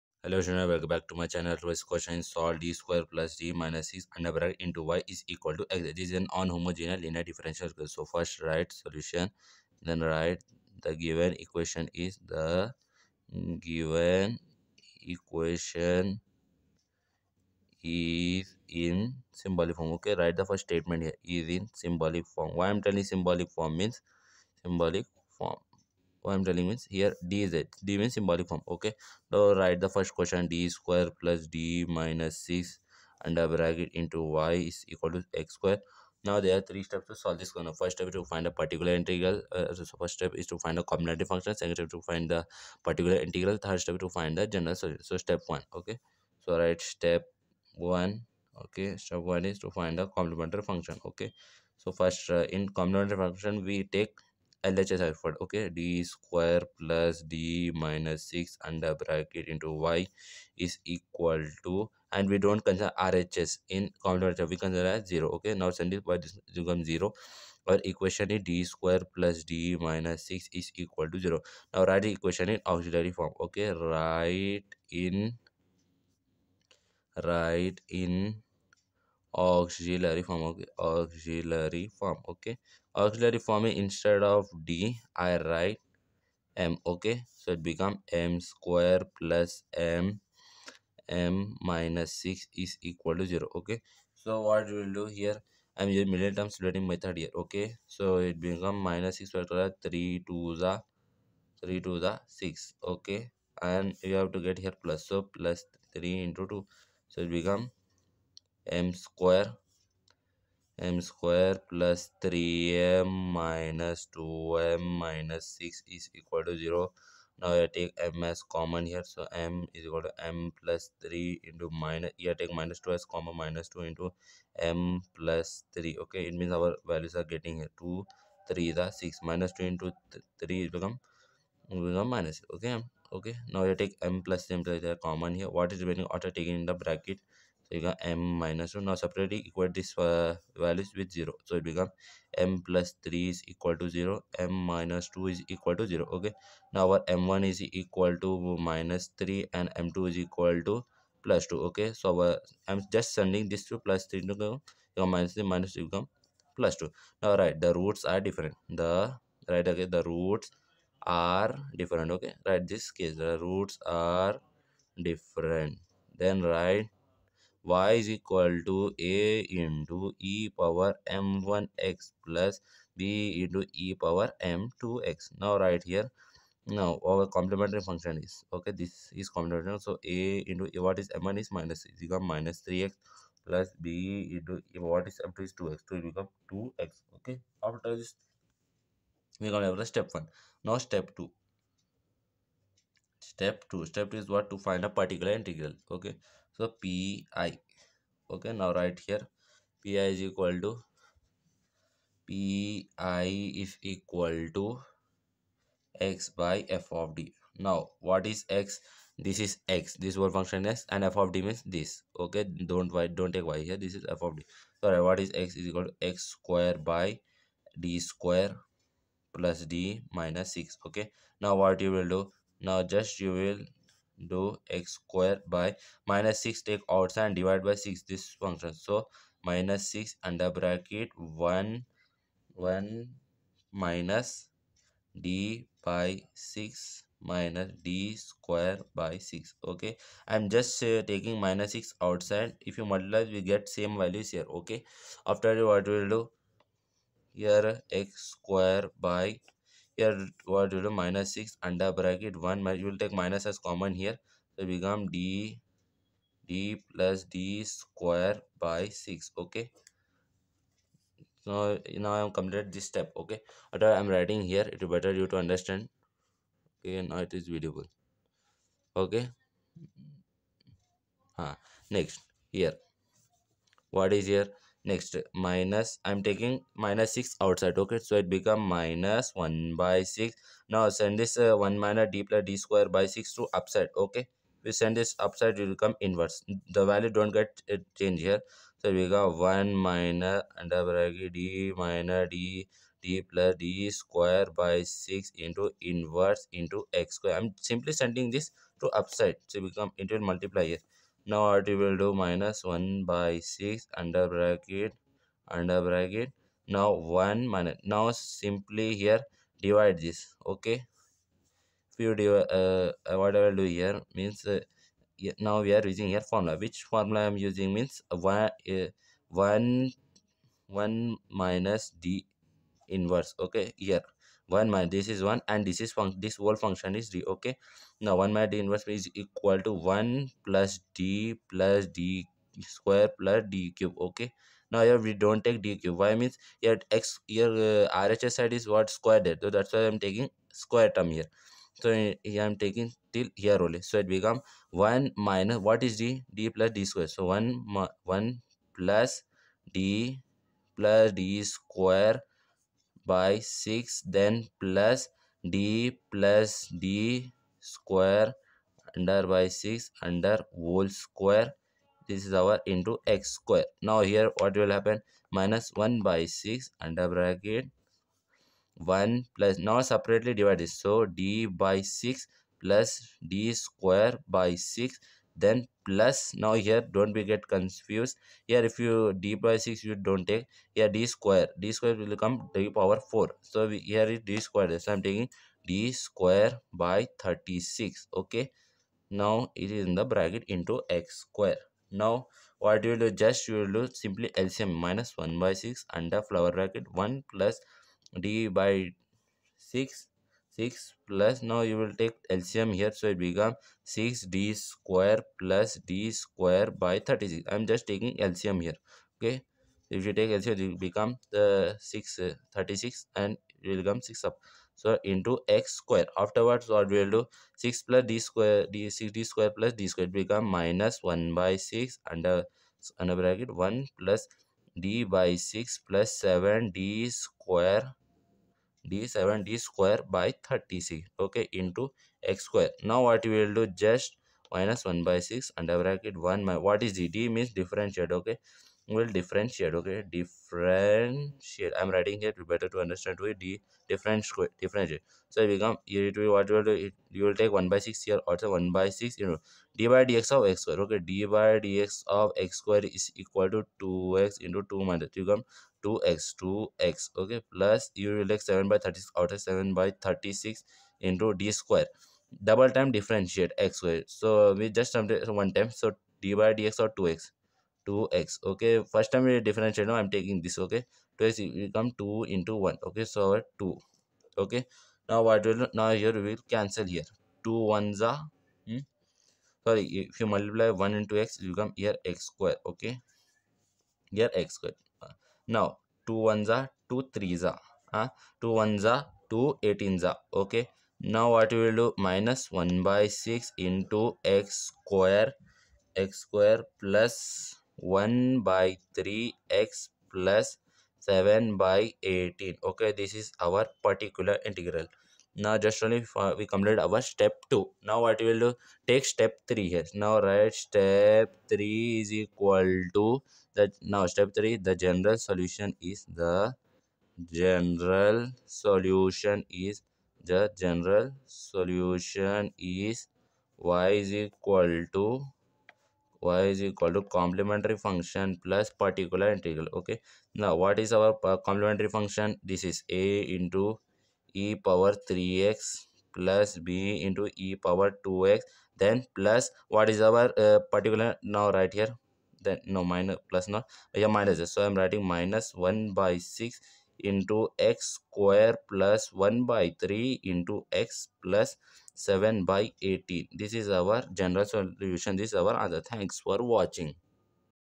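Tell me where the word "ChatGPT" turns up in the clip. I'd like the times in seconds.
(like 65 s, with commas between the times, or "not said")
not said.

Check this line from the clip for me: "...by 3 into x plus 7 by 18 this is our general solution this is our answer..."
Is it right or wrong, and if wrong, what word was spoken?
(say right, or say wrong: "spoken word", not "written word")
right.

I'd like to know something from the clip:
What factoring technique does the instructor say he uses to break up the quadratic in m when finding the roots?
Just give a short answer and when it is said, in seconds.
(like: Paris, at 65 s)
Middle term splitting, at 96 s.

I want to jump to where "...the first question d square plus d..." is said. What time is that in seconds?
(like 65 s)
29 s.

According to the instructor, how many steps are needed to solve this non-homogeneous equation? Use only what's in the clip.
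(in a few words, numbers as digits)
3.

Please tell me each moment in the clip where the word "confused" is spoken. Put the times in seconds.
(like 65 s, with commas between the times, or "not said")
377 s.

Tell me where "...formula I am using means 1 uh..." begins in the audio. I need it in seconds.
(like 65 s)
316 s.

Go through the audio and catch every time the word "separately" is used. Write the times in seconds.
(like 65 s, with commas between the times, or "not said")
138 s, 369 s.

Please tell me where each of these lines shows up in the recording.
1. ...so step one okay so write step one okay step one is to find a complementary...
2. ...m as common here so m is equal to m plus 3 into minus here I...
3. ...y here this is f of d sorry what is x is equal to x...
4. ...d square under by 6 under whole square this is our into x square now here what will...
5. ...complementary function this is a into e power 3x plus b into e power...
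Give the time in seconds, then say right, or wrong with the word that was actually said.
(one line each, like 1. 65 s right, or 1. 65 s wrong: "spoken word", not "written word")
1. 45 s right
2. 118 s right
3. 213 s right
4. 356 s right
5. 531 s right.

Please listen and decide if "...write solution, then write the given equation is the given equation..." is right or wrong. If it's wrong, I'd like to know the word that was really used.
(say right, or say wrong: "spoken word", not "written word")
right.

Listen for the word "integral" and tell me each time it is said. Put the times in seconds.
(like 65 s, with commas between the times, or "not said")
38 s, 43 s, 195 s, 504 s, 529 s.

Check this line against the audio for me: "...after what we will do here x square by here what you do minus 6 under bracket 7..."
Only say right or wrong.
wrong.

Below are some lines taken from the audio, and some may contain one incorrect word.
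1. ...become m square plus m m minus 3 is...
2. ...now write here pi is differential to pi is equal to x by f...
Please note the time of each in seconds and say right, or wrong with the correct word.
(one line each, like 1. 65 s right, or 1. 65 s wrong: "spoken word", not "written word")
1. 87 s wrong: "6", not "3"
2. 198 s wrong: "equal", not "differential".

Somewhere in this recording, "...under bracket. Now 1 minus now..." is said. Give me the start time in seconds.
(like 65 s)
305 s.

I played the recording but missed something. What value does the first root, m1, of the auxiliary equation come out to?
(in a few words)
-3.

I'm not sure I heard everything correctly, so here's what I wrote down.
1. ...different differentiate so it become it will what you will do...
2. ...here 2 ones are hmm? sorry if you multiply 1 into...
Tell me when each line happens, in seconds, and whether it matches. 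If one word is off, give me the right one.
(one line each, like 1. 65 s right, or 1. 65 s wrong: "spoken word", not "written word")
1. 443 s right
2. 476 s right.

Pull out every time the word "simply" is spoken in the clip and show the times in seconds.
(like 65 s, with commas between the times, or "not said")
297 s, 308 s, 393 s.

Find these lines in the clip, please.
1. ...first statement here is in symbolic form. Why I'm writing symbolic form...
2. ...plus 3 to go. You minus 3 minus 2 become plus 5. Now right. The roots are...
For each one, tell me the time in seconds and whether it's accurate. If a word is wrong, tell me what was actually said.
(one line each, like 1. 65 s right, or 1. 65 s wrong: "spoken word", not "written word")
1. 20 s wrong: "telling", not "writing"
2. 153 s wrong: "2", not "5".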